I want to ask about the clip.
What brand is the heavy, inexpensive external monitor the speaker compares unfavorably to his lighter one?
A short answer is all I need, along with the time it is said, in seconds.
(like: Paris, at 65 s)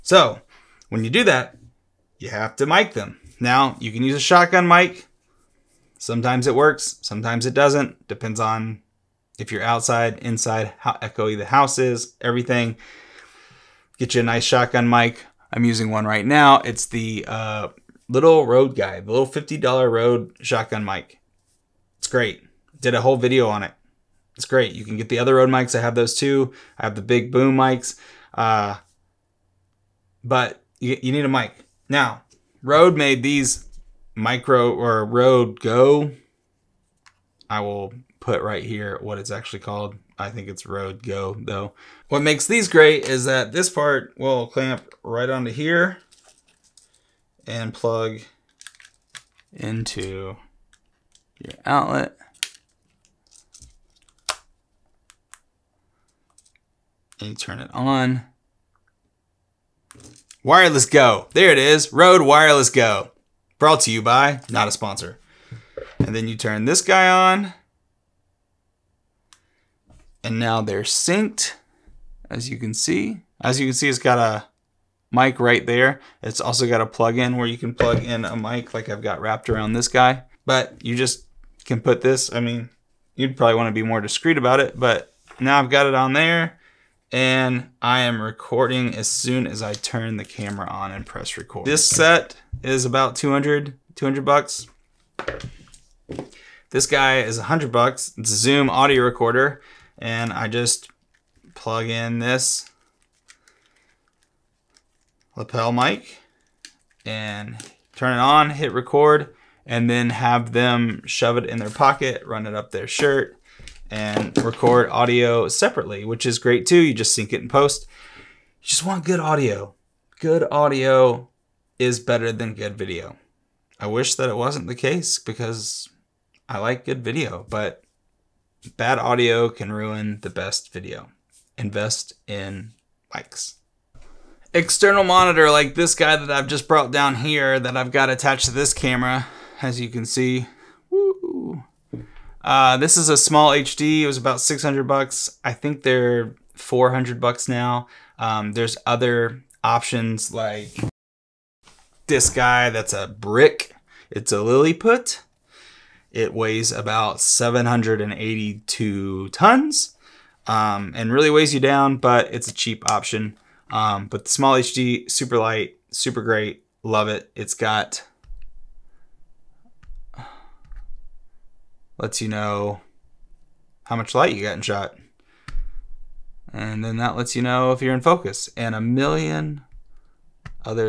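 Lilliput, at 154 s.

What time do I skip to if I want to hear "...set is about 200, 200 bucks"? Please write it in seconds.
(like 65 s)
91 s.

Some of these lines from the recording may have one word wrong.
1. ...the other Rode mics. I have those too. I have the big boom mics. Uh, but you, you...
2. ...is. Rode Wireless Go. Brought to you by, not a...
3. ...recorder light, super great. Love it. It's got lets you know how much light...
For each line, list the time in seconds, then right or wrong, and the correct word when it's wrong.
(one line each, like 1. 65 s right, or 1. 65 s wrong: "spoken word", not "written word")
1. 25 s right
2. 61 s right
3. 165 s wrong: "super", not "recorder".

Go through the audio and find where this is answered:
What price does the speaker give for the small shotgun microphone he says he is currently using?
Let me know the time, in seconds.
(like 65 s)
19 s.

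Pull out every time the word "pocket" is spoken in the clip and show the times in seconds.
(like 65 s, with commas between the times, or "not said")
111 s.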